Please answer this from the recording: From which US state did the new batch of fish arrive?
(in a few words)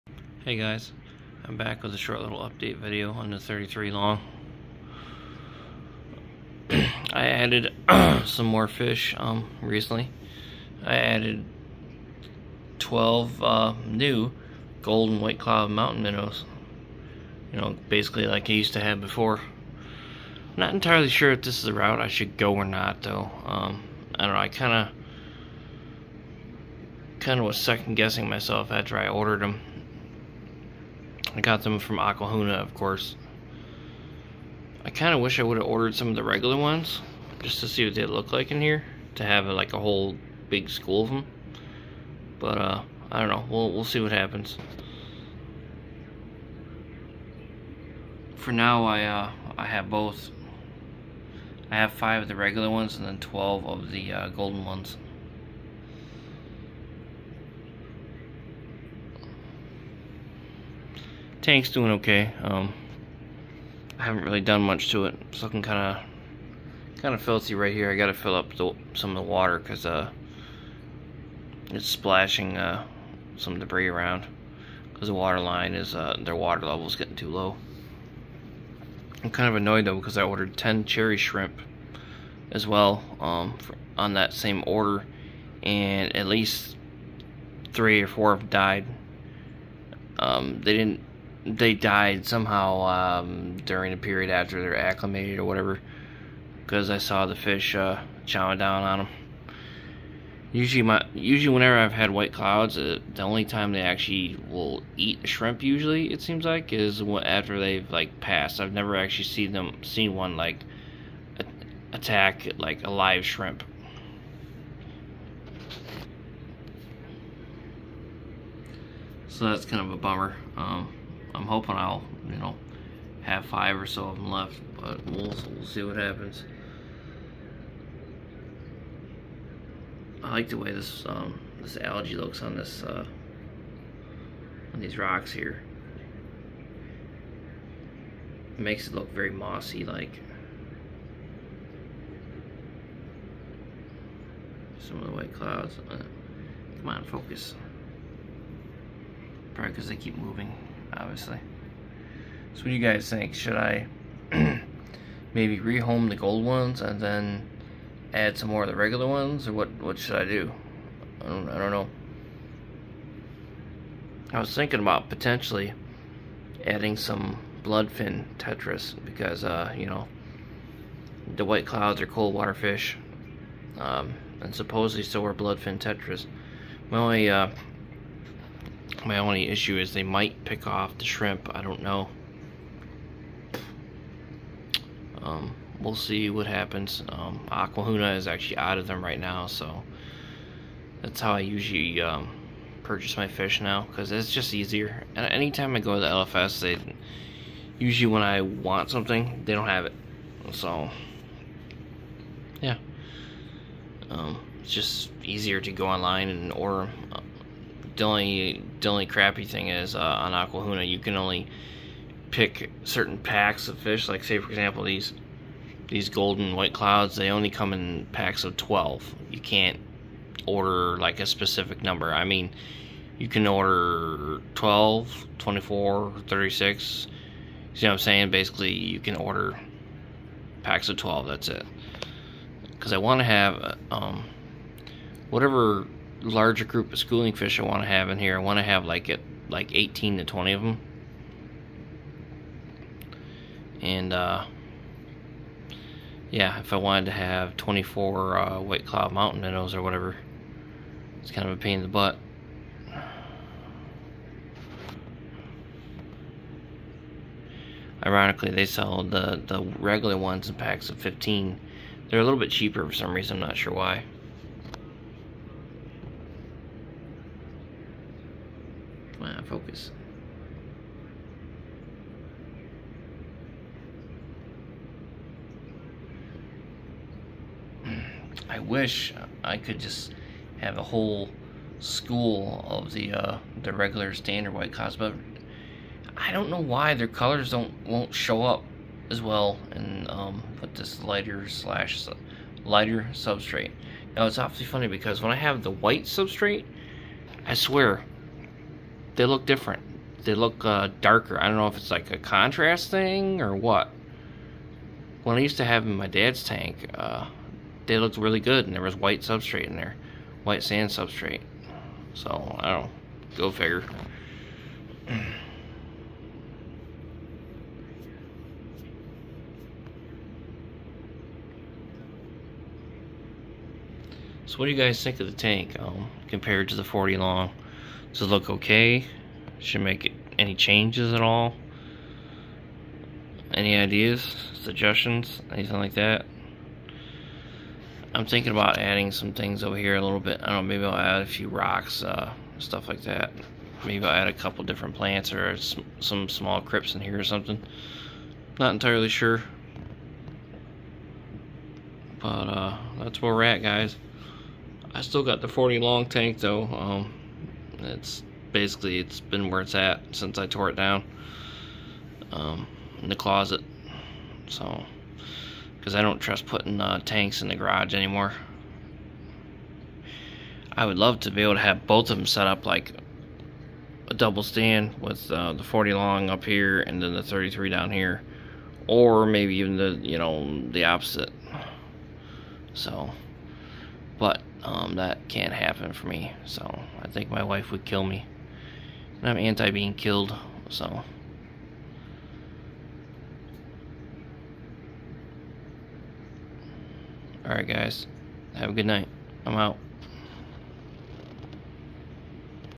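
Oklahoma.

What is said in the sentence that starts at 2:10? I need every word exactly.
I like the way this um, this algae looks on this uh, on these rocks here.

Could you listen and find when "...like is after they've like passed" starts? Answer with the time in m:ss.
1:46.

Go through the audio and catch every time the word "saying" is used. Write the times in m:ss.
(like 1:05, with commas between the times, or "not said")
3:47.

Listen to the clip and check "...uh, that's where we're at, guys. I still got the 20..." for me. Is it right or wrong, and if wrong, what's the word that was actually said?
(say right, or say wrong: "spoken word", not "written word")
wrong: "40", not "20".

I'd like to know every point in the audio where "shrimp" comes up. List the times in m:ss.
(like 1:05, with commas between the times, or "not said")
1:21, 1:45, 1:53, 3:01.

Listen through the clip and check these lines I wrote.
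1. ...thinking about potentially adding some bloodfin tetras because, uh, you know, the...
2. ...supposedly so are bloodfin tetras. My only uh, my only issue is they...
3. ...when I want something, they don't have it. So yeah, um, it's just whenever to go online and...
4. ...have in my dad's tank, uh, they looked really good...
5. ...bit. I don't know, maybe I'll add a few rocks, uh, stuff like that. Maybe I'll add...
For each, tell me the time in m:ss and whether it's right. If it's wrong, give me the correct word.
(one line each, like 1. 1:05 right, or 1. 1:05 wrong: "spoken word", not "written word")
1. 2:44 right
2. 2:54 right
3. 3:18 wrong: "easier", not "whenever"
4. 5:05 right
5. 5:40 right.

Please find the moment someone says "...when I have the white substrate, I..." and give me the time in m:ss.
4:55.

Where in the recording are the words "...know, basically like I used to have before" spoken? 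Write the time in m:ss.
0:17.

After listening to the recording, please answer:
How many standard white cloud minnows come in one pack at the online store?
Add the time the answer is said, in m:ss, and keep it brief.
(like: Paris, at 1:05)
15, at 4:20.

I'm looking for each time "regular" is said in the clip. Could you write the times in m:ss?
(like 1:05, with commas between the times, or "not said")
0:36, 0:52, 2:38, 4:19, 4:43.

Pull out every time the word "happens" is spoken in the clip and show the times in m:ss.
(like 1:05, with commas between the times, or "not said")
0:44, 2:05, 3:06, 6:25.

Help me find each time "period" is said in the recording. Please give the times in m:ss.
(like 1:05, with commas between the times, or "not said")
1:33.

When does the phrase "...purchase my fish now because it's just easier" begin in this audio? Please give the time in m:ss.
3:12.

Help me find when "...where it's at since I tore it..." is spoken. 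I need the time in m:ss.
5:59.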